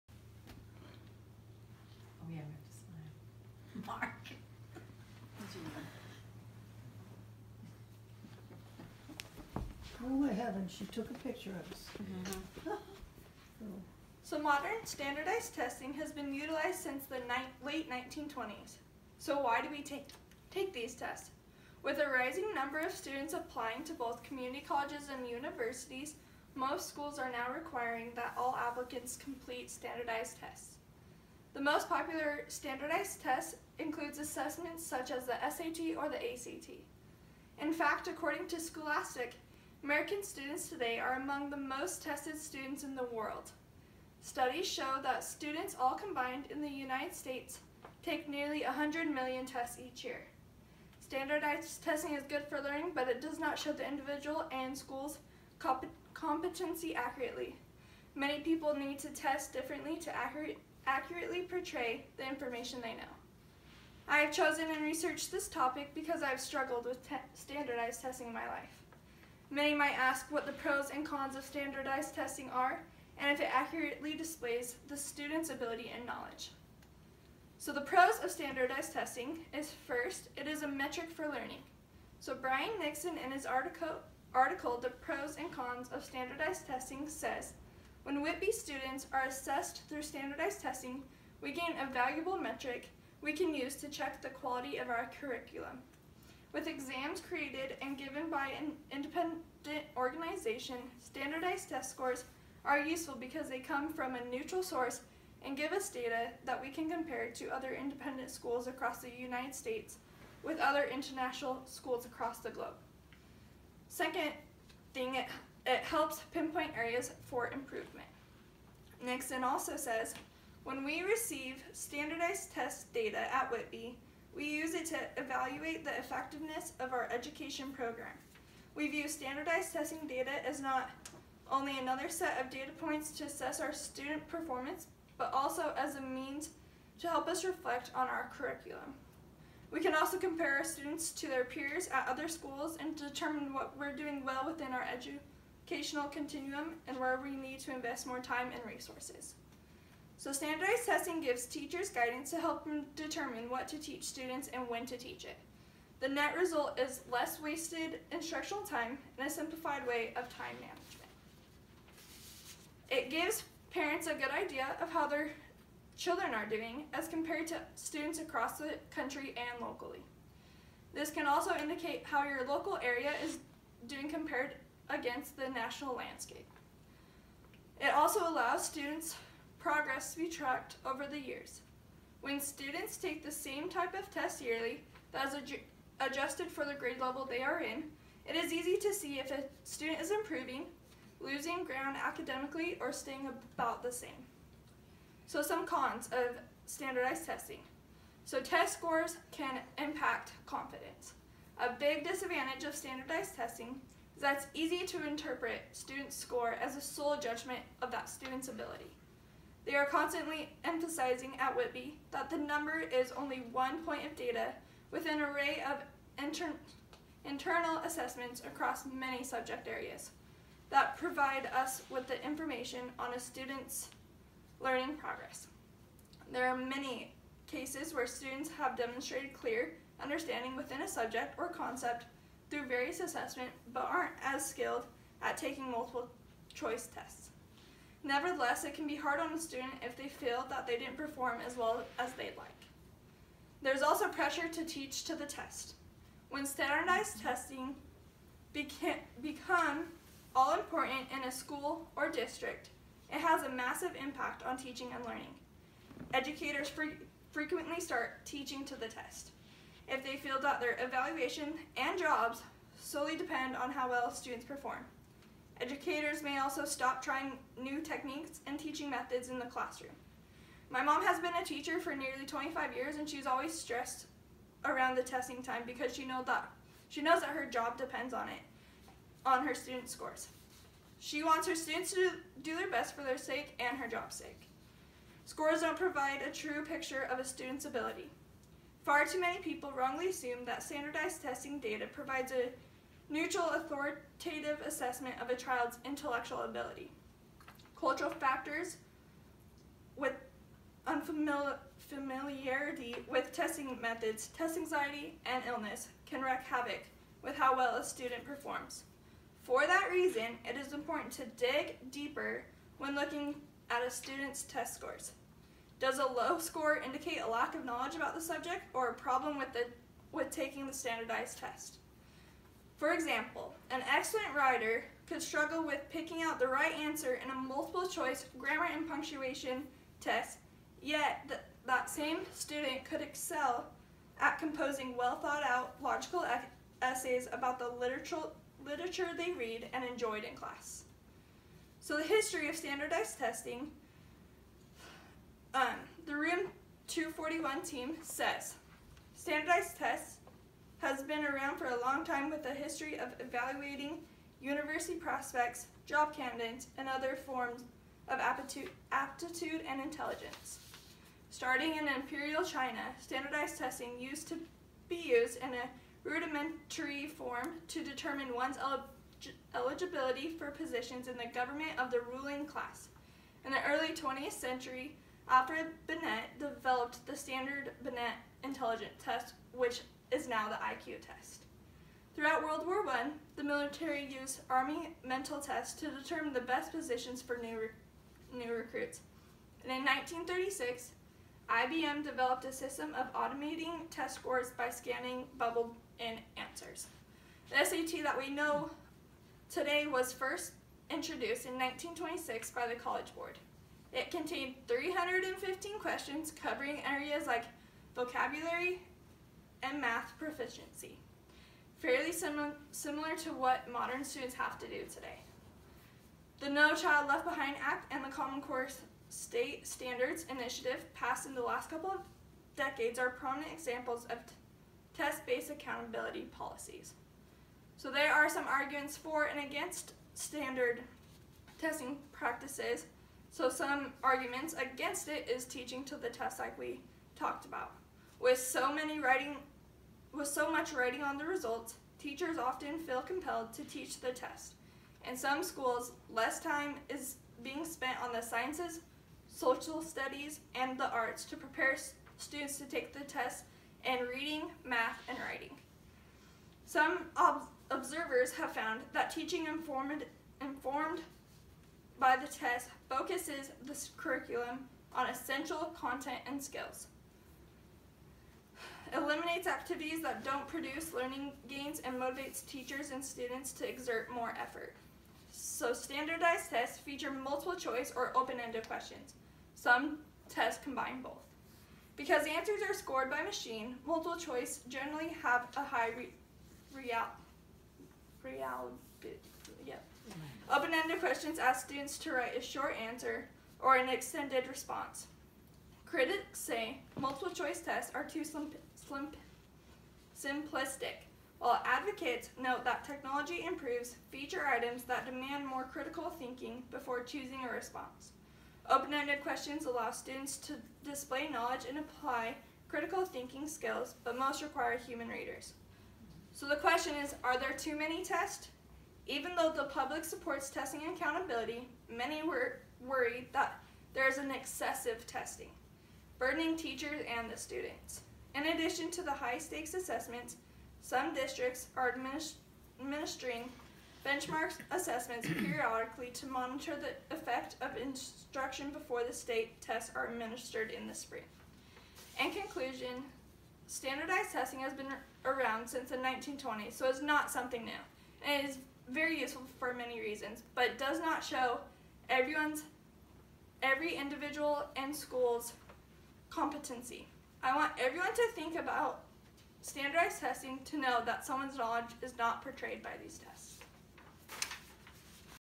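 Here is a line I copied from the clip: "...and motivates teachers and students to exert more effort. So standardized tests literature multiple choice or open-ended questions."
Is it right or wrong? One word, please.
wrong.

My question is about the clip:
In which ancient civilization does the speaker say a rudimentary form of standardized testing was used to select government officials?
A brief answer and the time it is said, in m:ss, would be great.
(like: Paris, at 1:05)
imperial China, at 6:01.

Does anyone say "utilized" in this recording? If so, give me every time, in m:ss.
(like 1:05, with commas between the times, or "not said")
0:16.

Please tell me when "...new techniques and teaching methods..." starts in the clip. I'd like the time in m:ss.
4:27.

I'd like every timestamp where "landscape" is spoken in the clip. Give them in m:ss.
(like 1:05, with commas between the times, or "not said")
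2:55.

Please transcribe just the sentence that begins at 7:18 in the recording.
With so many writing with so much writing on the results, teachers often feel compelled to teach the test.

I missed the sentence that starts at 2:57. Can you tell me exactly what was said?
It also allows students progress to be tracked over the years.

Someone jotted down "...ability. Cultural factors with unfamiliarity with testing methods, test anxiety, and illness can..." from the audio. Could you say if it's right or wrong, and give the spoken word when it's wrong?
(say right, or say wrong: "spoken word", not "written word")
right.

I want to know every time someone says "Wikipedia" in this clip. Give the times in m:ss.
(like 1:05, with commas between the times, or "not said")
not said.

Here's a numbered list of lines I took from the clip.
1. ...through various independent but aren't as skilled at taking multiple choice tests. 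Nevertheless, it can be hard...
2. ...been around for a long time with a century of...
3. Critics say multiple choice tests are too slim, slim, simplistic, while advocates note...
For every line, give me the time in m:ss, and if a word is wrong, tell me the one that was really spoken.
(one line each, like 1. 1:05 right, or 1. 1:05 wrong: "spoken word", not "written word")
1. 3:52 wrong: "assessment", not "independent"
2. 5:51 wrong: "history", not "century"
3. 8:15 right.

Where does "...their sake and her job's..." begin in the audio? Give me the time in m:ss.
4:43.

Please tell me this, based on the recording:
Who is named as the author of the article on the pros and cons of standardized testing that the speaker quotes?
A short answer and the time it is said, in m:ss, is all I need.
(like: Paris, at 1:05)
Brian Nixon, at 1:22.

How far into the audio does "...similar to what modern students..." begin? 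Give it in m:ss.
6:52.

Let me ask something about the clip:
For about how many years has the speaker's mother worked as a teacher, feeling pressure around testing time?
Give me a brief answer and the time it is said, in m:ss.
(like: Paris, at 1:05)
nearly 25 years, at 4:31.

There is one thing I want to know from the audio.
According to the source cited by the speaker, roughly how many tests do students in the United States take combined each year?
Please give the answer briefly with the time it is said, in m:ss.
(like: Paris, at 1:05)
nearly 100 million, at 0:48.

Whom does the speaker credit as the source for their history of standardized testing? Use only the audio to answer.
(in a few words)
Room 241.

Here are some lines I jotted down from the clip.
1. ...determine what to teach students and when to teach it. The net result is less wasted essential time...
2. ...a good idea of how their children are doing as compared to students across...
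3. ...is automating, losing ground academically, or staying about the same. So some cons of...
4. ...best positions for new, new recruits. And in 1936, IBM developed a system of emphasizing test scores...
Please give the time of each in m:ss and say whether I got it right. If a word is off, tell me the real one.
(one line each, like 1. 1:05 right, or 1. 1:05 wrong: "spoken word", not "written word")
1. 2:32 wrong: "instructional", not "essential"
2. 2:44 right
3. 3:09 wrong: "improving", not "automating"
4. 6:26 wrong: "automating", not "emphasizing".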